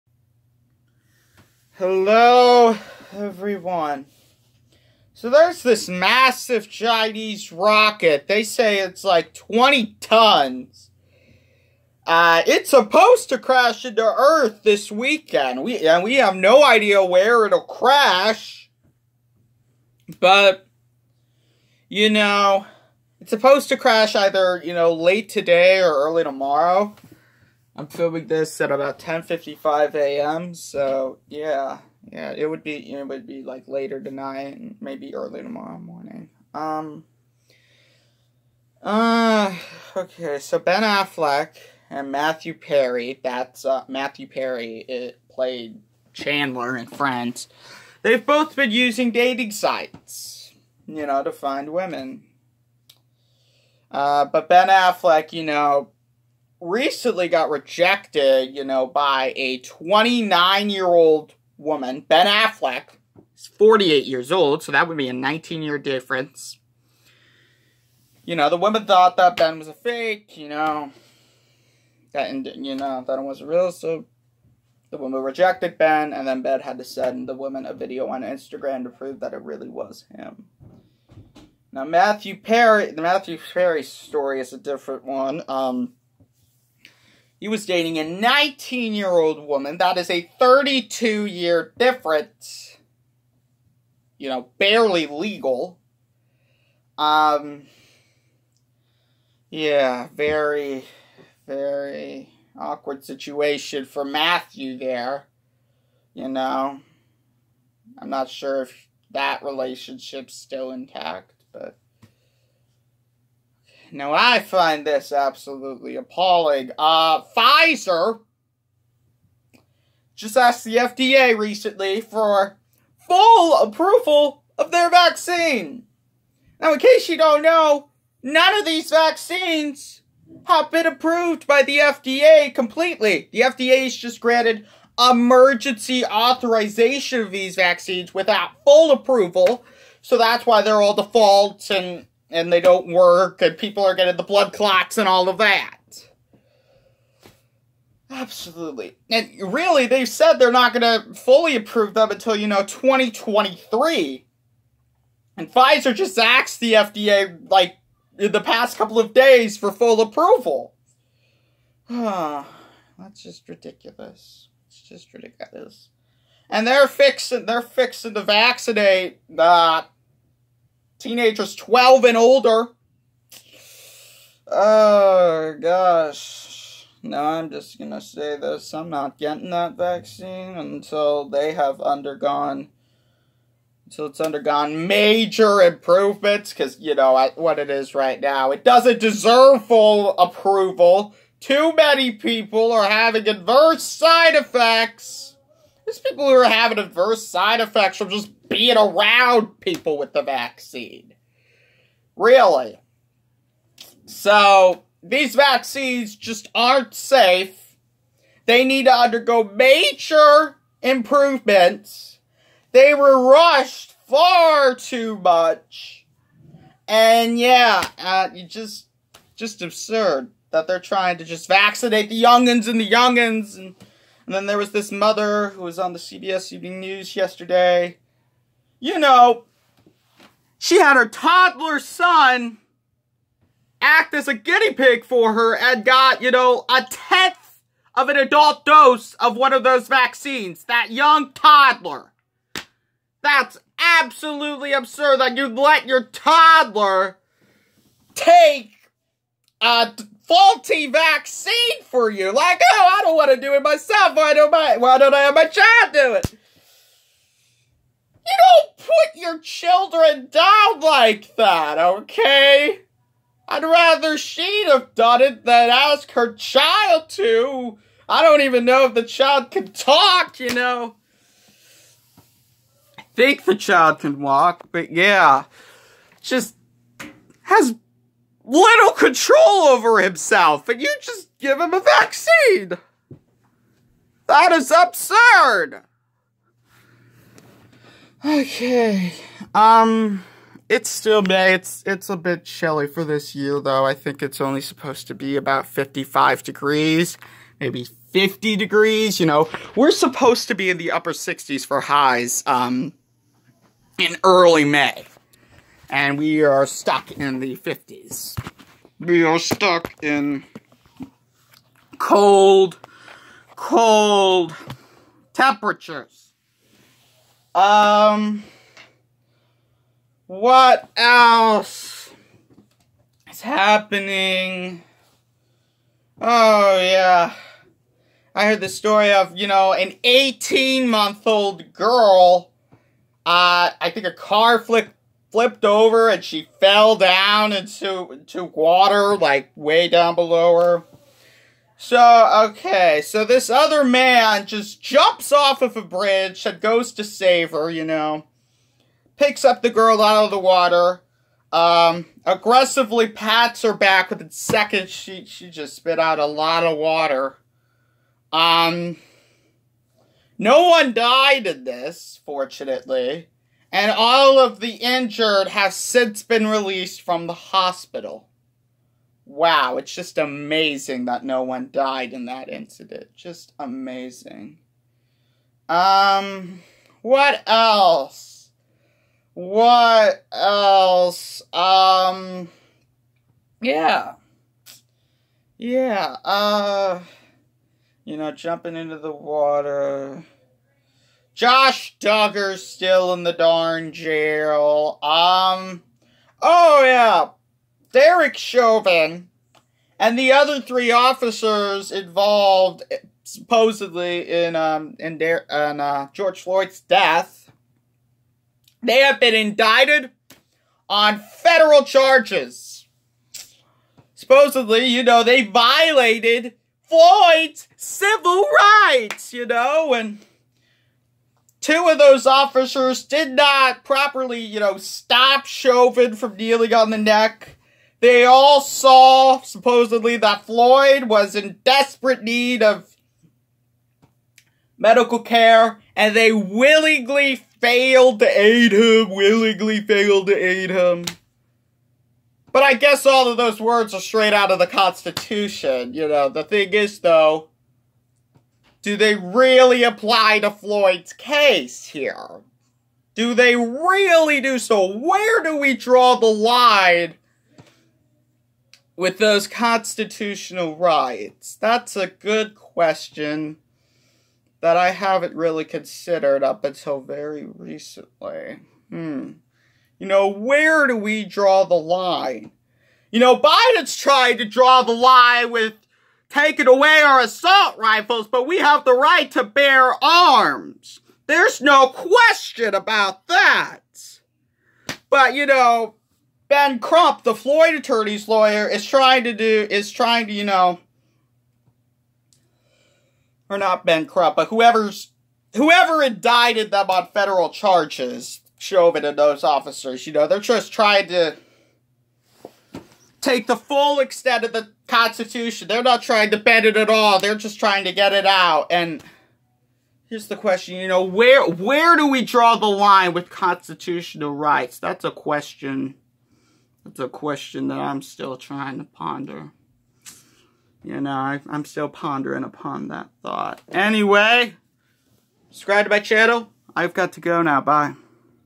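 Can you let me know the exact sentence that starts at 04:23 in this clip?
I'd rather she'd have done it than ask her child to.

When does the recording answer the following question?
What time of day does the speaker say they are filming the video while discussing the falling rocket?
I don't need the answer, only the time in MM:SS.
00:28.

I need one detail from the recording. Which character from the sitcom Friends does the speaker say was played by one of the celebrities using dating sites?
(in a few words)
Chandler.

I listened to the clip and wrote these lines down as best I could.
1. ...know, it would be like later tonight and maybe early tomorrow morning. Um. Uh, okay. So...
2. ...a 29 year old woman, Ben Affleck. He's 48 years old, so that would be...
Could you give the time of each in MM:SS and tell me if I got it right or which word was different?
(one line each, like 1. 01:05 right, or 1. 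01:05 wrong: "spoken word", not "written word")
1. 00:32 right
2. 00:59 right.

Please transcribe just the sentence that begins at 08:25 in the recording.
They're not trying to bend it at all.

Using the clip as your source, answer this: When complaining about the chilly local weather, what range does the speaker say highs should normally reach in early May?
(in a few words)
upper 60s.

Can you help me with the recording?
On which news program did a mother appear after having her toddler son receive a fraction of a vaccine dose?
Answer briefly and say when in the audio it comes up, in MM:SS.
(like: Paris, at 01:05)
CBS Evening News, at 03:45.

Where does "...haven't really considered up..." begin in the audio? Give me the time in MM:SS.
07:44.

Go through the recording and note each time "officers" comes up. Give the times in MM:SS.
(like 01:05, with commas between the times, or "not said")
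06:40, 07:02, 08:19.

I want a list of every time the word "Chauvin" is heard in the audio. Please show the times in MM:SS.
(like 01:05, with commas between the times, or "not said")
06:38, 07:05, 08:18.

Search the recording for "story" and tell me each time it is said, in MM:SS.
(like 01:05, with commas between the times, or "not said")
01:23, 05:28.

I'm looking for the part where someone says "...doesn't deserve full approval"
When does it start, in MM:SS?
03:08.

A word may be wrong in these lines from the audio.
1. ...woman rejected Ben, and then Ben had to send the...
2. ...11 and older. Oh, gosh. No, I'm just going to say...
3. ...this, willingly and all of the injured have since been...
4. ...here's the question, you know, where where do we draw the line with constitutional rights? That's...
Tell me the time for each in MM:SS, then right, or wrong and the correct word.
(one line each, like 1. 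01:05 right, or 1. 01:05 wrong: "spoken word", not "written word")
1. 01:14 right
2. 02:51 wrong: "12", not "11"
3. 06:01 wrong: "fortunately", not "willingly"
4. 08:30 right.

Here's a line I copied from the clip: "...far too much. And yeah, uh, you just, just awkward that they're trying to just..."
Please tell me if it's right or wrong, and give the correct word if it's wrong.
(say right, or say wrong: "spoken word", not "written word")
wrong: "absurd", not "awkward".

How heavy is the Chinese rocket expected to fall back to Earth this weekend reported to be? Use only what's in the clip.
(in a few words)
20 tons.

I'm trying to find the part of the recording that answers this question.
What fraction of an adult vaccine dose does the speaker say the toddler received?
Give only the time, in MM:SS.
03:56.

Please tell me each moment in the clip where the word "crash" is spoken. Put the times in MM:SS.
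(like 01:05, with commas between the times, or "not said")
00:13, 00:17, 00:23.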